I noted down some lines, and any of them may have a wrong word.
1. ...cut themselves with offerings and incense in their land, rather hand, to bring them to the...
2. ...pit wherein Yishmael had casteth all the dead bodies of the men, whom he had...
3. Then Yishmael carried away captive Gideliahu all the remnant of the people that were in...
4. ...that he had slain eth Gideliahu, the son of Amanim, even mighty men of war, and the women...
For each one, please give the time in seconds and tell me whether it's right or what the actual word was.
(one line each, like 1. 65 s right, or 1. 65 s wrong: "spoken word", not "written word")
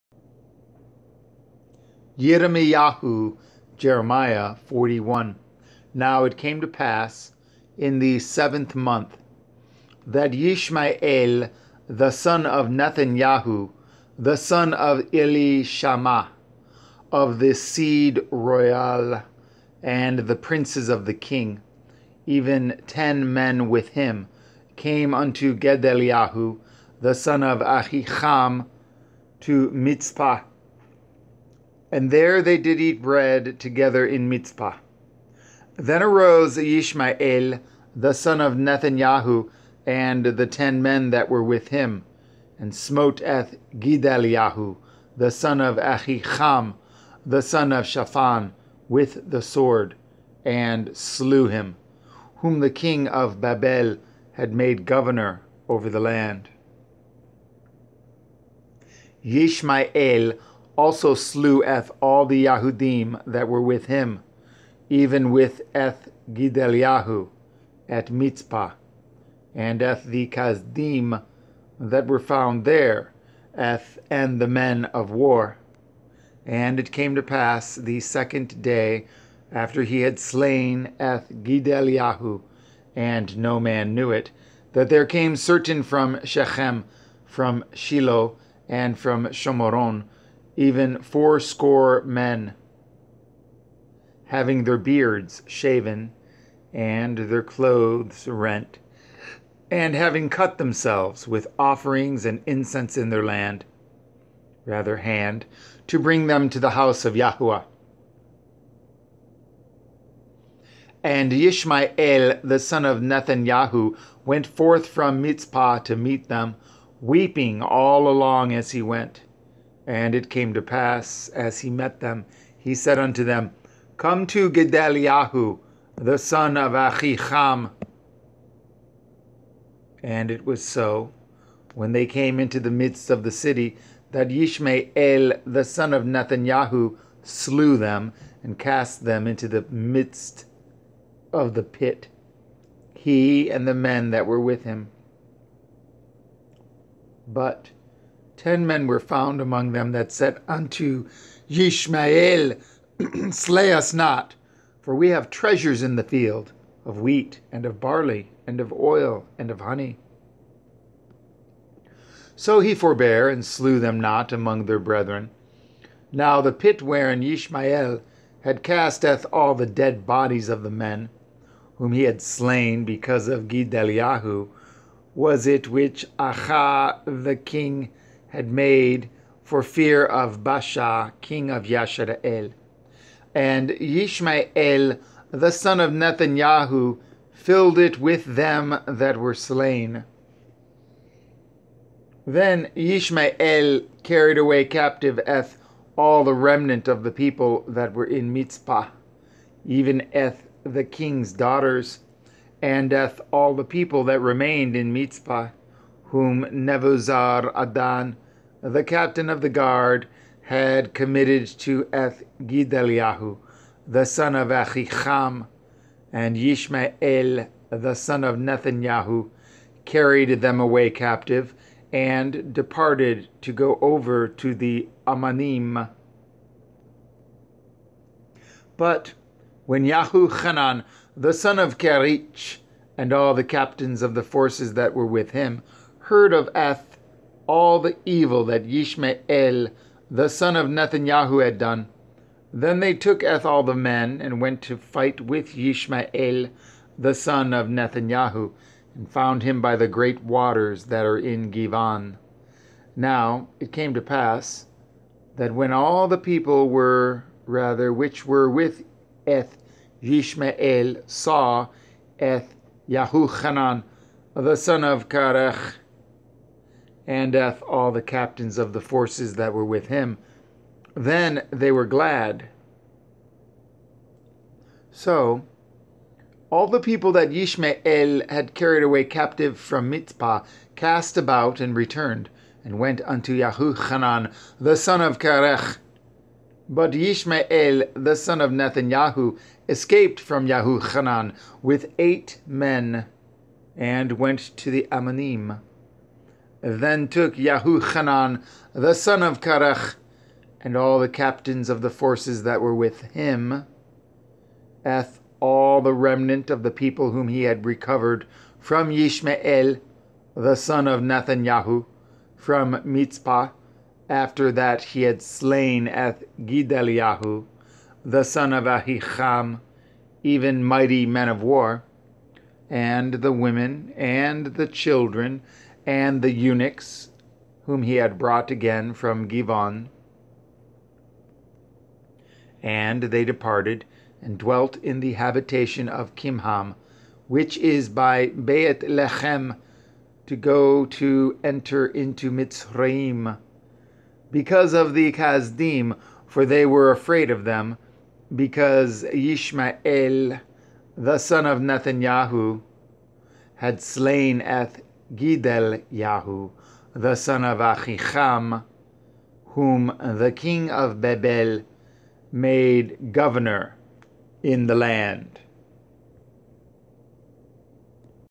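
1. 100 s right
2. 166 s right
3. 192 s wrong: "Eth", not "Gideliahu"
4. 314 s wrong: "Ahicham", not "Amanim".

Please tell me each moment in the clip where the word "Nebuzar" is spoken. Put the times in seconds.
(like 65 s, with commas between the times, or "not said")
206 s.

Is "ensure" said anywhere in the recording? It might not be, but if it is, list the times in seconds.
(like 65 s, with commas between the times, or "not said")
not said.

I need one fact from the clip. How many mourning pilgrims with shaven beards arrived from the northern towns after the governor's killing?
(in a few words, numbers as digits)
80.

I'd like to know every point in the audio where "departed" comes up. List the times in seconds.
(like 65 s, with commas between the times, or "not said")
222 s, 333 s.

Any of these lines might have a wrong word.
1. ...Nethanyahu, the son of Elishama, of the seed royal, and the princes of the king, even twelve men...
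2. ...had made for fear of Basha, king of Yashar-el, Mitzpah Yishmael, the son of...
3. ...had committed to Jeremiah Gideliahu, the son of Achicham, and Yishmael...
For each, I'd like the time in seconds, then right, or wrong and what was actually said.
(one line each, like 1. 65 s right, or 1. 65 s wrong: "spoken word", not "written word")
1. 12 s wrong: "ten", not "twelve"
2. 178 s wrong: "And", not "Mitzpah"
3. 210 s wrong: "Eth", not "Jeremiah".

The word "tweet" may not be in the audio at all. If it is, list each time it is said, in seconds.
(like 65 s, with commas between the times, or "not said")
not said.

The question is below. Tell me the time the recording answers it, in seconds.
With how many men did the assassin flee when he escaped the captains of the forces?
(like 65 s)
291 s.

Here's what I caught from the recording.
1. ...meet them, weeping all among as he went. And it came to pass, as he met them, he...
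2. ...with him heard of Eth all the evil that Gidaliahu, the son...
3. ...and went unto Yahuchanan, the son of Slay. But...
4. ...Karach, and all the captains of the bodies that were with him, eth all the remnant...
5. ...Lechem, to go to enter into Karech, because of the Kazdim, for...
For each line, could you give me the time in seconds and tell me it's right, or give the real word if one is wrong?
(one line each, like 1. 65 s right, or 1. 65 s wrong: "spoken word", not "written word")
1. 115 s wrong: "along", not "among"
2. 235 s wrong: "Yishmael", not "Gidaliahu"
3. 282 s wrong: "Karech", not "Slay"
4. 299 s wrong: "forces", not "bodies"
5. 338 s wrong: "Mitzrayim", not "Karech".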